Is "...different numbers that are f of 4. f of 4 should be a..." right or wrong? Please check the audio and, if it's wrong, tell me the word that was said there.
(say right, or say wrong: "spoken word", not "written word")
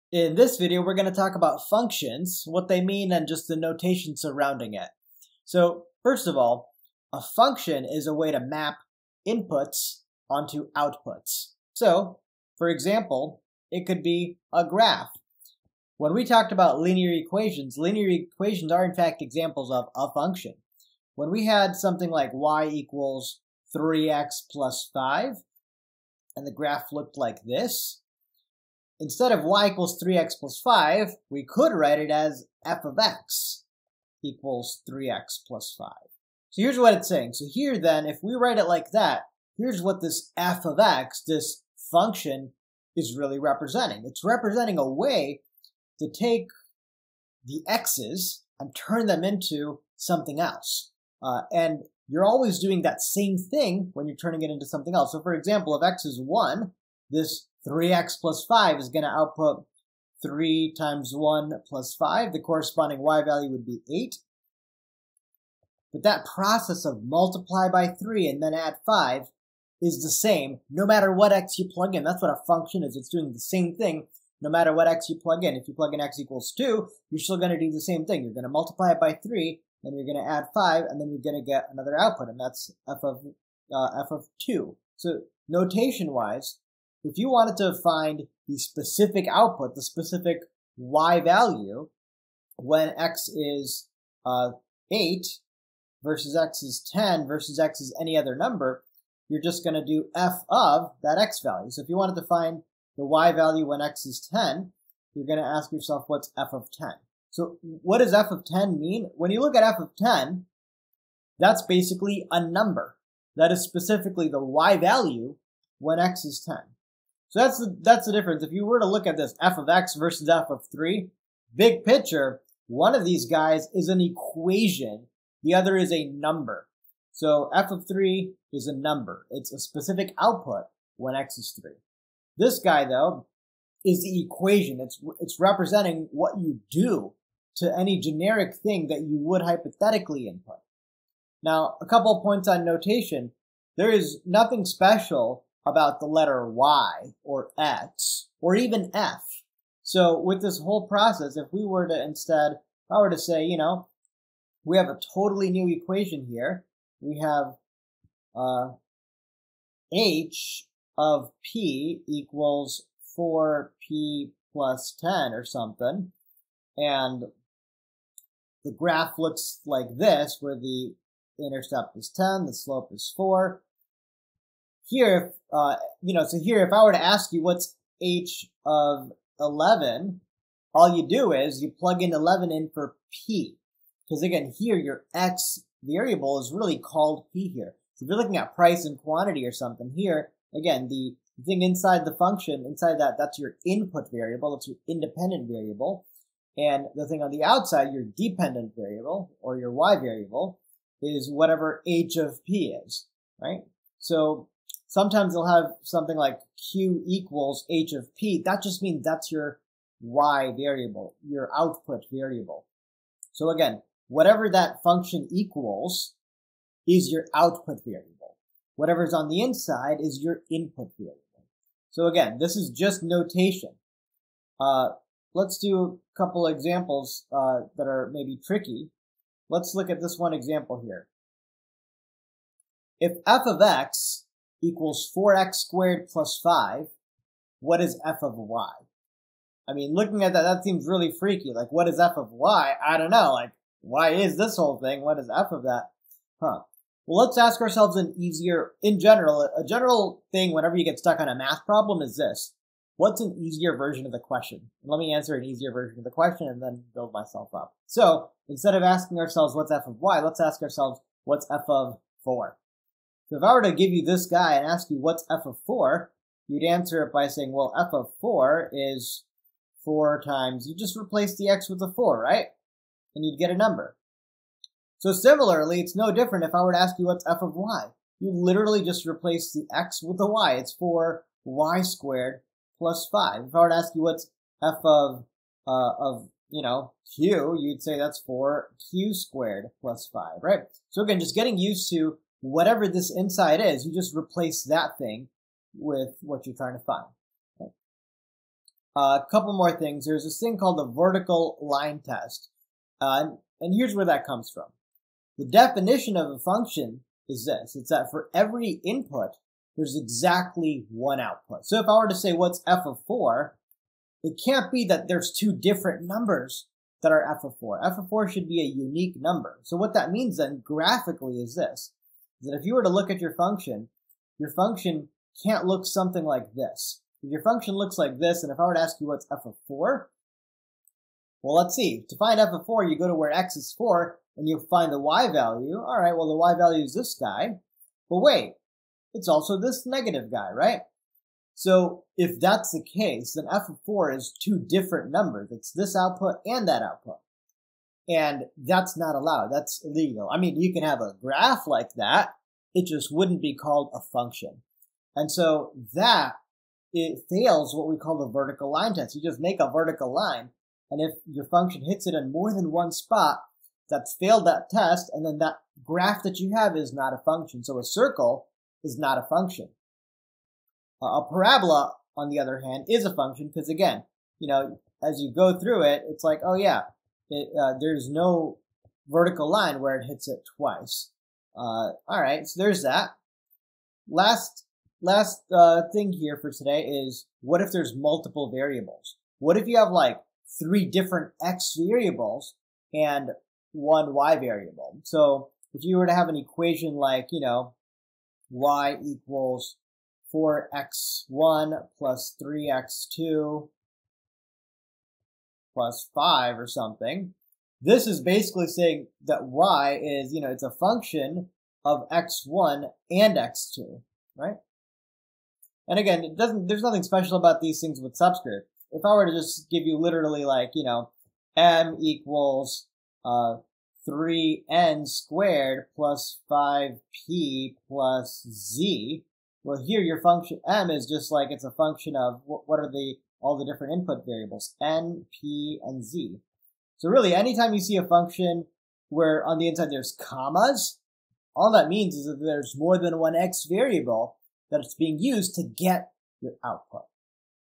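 right.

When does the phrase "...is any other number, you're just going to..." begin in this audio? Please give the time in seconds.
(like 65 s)
97 s.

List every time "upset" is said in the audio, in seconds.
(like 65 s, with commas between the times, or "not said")
not said.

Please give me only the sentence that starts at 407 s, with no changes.
This is basically saying that y is, you know, it's a function of x1 and x2, right?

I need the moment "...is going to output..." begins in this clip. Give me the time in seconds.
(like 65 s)
58 s.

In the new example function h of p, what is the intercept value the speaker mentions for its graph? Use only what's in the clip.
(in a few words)
10.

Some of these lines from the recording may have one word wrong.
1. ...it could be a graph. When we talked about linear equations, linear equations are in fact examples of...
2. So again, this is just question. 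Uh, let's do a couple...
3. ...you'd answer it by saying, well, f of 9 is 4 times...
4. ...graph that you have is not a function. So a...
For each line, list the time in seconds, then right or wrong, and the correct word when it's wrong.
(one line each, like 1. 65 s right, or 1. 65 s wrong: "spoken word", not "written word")
1. 13 s right
2. 221 s wrong: "notation", not "question"
3. 266 s wrong: "4", not "9"
4. 365 s right.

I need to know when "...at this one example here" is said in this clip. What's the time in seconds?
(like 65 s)
229 s.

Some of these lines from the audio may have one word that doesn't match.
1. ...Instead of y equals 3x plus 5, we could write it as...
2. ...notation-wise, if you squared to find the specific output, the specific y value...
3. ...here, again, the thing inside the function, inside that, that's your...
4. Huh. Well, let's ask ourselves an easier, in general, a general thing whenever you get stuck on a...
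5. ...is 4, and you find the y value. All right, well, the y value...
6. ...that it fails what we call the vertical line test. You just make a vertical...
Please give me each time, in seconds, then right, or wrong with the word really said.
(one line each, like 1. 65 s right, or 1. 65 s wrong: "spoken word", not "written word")
1. 29 s right
2. 85 s wrong: "wanted", not "squared"
3. 189 s right
4. 246 s right
5. 333 s right
6. 355 s right.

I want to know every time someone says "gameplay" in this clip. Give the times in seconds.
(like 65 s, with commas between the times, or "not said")
not said.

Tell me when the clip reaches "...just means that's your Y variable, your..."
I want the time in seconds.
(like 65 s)
208 s.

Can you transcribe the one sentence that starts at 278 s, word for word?
You literally just replace the x with the y.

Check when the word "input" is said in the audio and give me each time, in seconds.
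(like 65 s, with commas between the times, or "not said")
9 s, 140 s, 193 s, 220 s, 308 s, 433 s.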